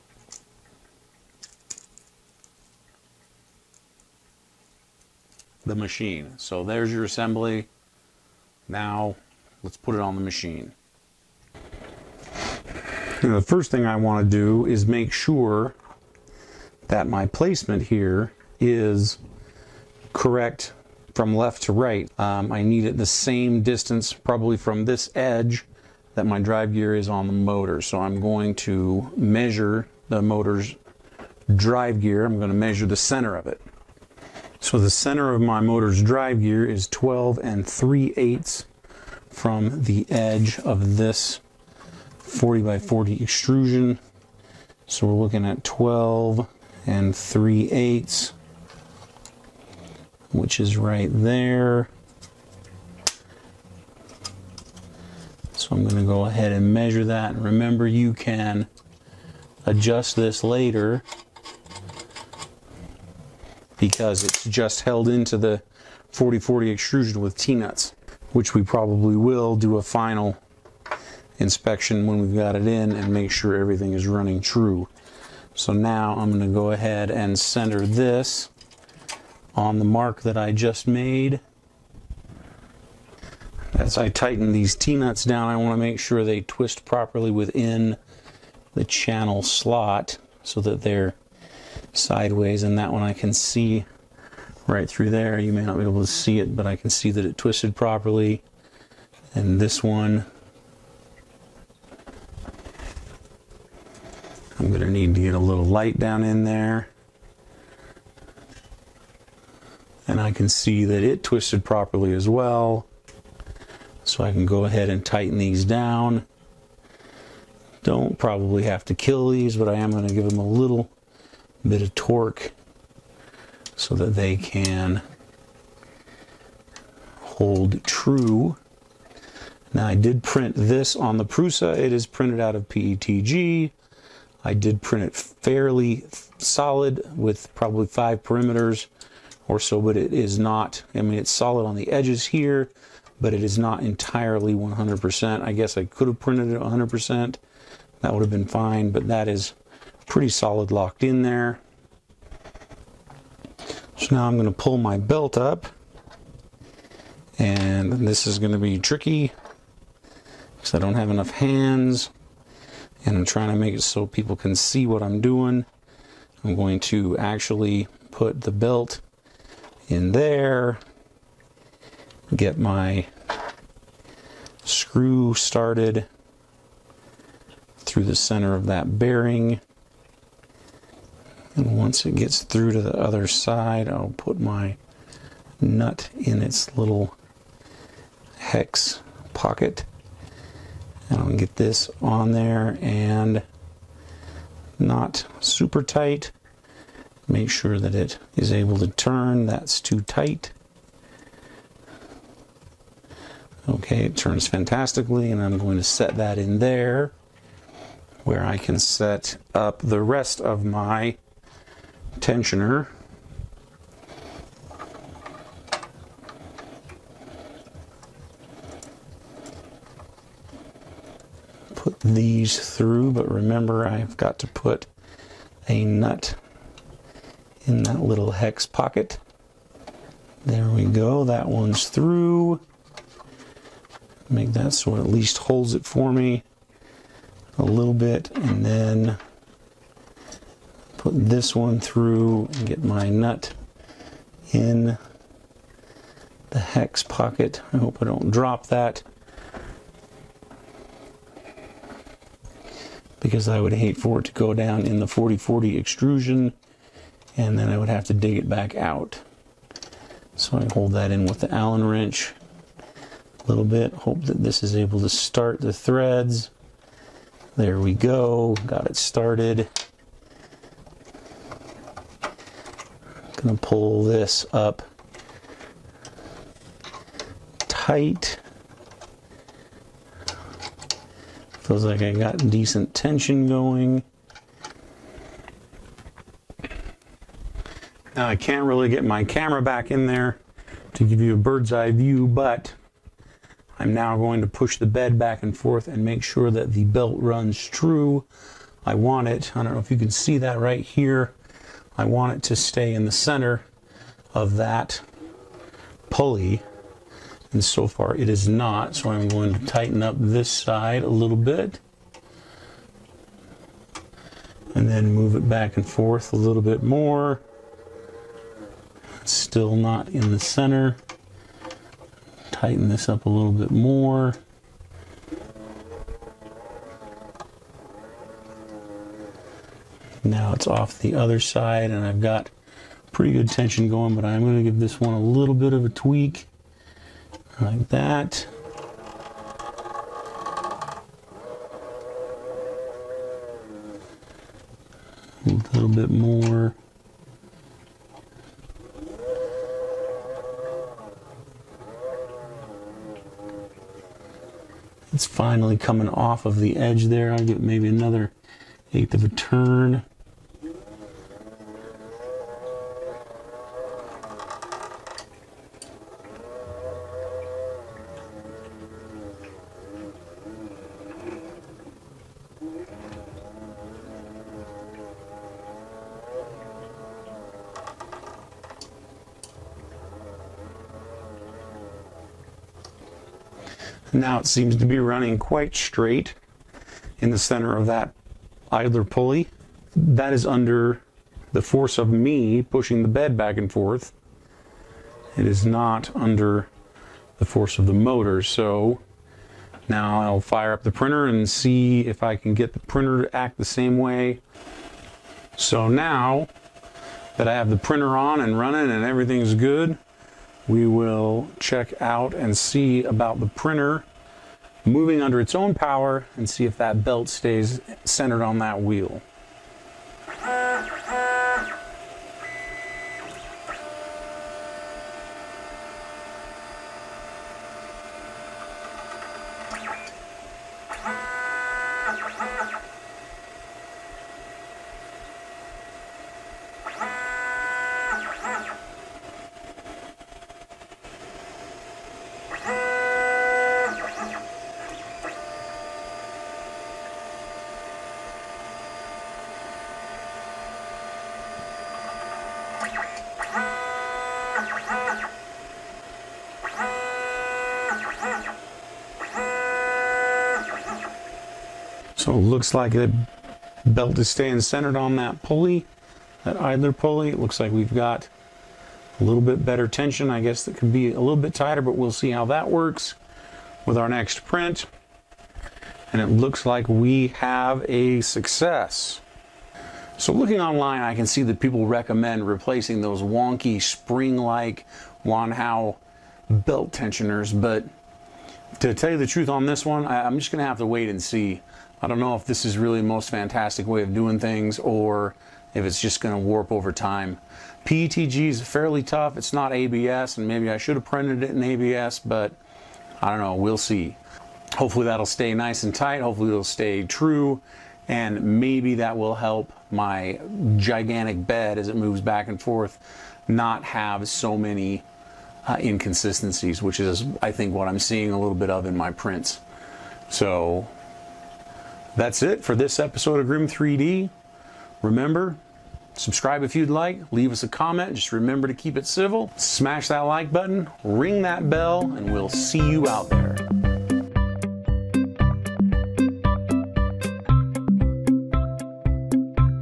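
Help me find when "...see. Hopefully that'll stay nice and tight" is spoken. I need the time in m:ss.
8:23.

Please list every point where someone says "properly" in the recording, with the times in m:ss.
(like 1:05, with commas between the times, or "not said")
1:26, 1:37, 1:51.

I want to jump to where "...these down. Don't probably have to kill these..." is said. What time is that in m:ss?
1:55.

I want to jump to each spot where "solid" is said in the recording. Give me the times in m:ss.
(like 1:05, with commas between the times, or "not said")
2:16, 2:21, 2:30.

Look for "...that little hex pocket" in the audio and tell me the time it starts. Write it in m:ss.
3:47.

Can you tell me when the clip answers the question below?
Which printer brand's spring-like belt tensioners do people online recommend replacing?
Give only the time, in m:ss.
8:05.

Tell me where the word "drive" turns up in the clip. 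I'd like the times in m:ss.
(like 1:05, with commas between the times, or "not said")
0:26, 0:31, 0:36.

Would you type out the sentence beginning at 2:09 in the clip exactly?
Now I did print this on the Prusa.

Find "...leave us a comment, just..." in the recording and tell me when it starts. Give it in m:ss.
8:47.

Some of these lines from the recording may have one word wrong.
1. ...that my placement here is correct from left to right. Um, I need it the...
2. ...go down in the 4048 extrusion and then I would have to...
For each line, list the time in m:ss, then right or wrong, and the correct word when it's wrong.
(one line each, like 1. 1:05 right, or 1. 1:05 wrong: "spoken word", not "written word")
1. 0:16 right
2. 4:14 wrong: "4040", not "4048".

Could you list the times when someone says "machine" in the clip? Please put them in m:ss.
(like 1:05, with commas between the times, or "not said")
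0:05, 0:10.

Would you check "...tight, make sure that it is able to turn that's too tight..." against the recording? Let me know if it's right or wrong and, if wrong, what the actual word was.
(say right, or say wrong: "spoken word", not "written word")
right.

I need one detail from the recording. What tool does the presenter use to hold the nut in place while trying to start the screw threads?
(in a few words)
Allen wrench.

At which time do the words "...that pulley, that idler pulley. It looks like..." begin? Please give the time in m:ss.
7:45.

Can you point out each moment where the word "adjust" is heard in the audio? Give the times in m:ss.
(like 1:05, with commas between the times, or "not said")
0:59.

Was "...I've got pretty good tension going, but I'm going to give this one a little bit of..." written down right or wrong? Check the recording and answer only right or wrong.
right.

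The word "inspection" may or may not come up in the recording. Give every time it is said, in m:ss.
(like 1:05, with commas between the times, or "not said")
1:11.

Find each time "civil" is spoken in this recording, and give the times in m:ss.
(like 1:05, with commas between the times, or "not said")
8:49.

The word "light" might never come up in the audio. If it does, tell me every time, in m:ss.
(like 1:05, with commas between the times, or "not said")
1:45.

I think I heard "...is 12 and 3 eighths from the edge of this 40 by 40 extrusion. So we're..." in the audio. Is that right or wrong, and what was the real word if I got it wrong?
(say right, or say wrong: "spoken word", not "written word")
right.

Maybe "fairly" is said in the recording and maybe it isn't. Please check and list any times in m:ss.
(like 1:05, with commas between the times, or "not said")
2:15, 8:18.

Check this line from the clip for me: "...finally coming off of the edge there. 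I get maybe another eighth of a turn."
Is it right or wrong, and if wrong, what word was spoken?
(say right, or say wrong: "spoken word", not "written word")
right.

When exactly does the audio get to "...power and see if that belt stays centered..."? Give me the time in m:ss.
6:55.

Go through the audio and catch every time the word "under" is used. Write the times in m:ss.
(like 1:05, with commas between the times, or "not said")
6:30, 6:36, 6:55.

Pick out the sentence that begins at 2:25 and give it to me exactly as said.
I guess I could have printed it 100%.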